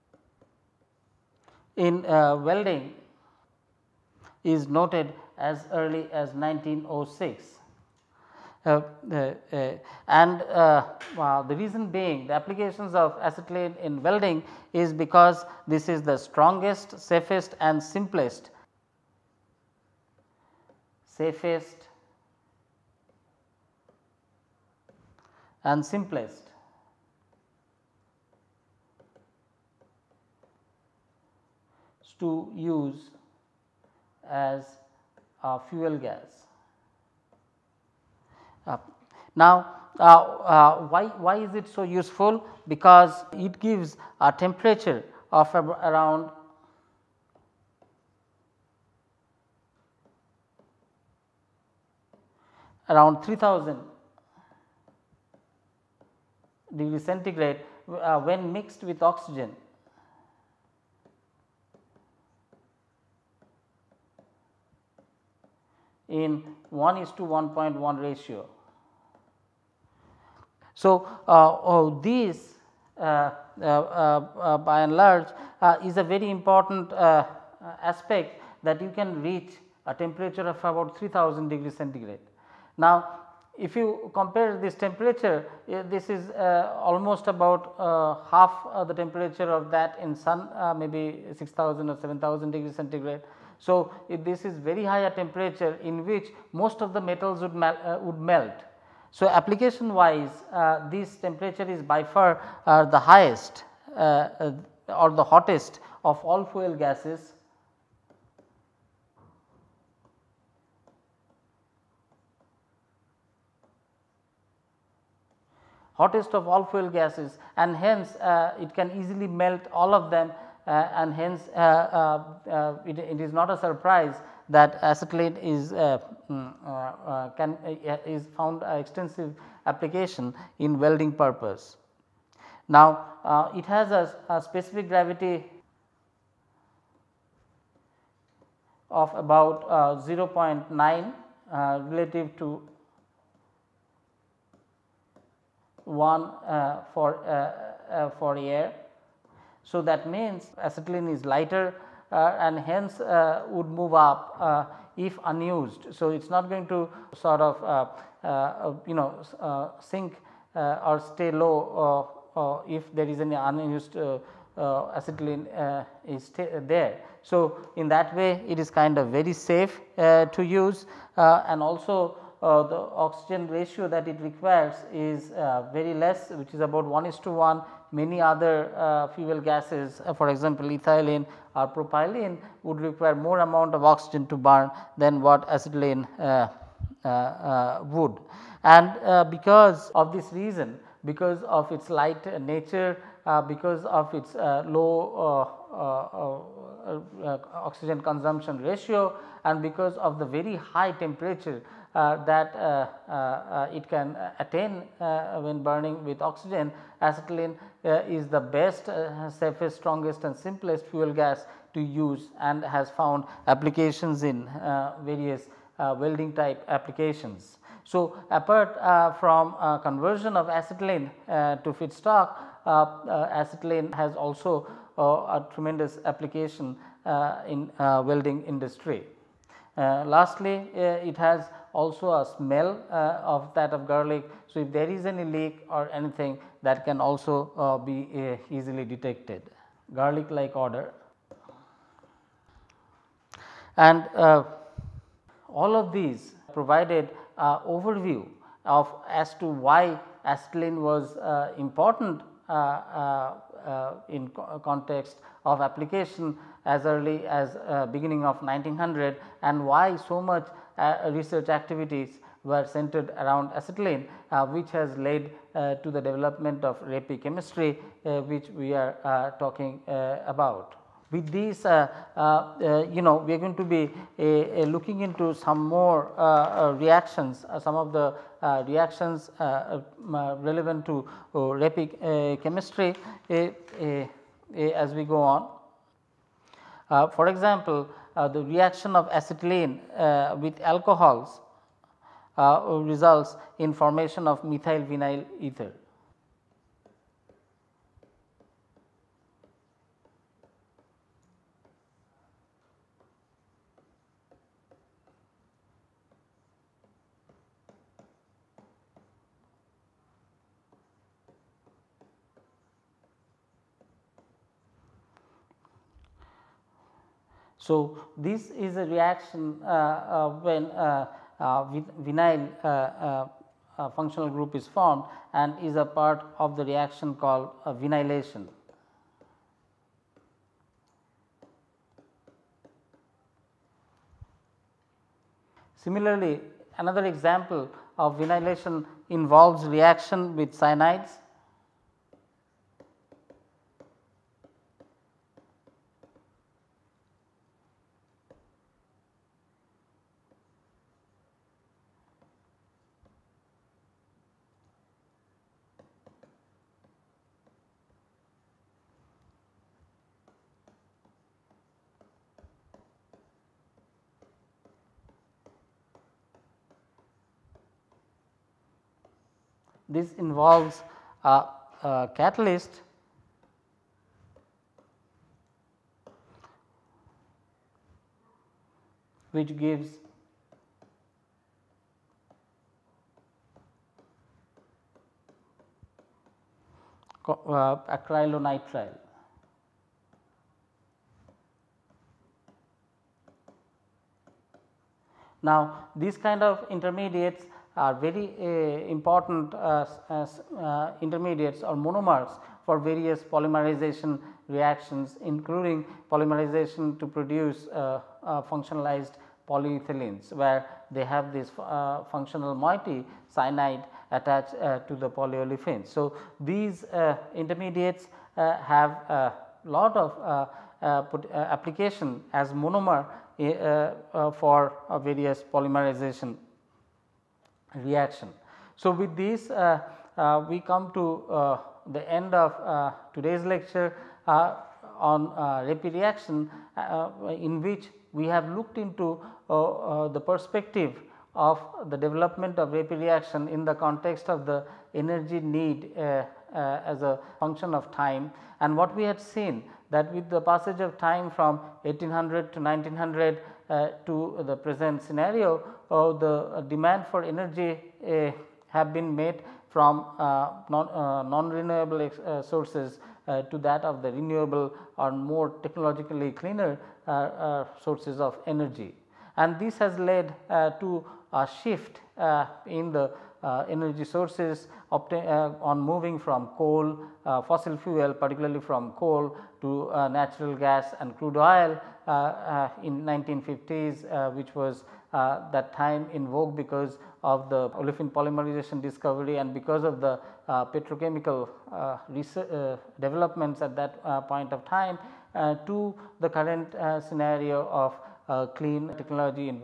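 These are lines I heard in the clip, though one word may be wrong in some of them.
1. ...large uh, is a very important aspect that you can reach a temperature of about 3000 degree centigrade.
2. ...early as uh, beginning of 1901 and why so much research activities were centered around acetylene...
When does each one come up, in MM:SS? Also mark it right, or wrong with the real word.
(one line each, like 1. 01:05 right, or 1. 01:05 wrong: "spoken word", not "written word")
1. 01:14 right
2. 04:16 wrong: "1900", not "1901".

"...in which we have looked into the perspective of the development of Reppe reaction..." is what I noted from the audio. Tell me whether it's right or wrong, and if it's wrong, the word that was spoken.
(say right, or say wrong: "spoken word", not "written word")
right.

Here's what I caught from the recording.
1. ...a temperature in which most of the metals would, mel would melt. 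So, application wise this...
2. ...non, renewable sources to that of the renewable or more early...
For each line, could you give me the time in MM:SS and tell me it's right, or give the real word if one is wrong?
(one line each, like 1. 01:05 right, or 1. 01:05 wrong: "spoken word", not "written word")
1. 01:34 right
2. 07:40 wrong: "technologically", not "early".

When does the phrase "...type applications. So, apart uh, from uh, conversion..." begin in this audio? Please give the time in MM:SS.
03:36.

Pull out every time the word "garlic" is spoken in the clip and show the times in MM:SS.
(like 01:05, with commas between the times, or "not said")
03:53, 03:59.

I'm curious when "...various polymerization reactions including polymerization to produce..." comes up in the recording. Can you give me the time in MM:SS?
06:42.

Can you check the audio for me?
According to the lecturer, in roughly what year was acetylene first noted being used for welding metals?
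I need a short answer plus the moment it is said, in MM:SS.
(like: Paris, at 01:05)
1906, at 00:06.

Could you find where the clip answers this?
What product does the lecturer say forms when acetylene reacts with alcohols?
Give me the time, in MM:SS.
04:54.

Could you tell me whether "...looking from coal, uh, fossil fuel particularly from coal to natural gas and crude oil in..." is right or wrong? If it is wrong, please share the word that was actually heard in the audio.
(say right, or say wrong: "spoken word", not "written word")
wrong: "moving", not "looking".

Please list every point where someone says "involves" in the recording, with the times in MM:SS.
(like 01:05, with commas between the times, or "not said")
05:39, 06:10.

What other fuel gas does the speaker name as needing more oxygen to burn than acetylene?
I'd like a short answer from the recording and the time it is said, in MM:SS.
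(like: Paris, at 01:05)
ethylene or propylene, at 03:00.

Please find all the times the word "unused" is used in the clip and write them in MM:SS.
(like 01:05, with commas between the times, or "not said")
02:35, 02:43.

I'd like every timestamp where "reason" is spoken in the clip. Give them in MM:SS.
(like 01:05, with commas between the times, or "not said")
00:11, 03:10.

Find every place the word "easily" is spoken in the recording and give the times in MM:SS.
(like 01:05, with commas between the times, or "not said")
01:59, 03:58.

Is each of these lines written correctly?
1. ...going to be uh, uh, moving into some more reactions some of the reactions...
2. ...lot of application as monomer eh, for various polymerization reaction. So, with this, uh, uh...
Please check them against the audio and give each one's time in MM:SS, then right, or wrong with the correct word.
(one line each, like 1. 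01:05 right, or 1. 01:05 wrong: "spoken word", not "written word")
1. 04:33 wrong: "looking", not "moving"
2. 06:59 right.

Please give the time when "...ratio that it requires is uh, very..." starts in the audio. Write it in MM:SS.
02:53.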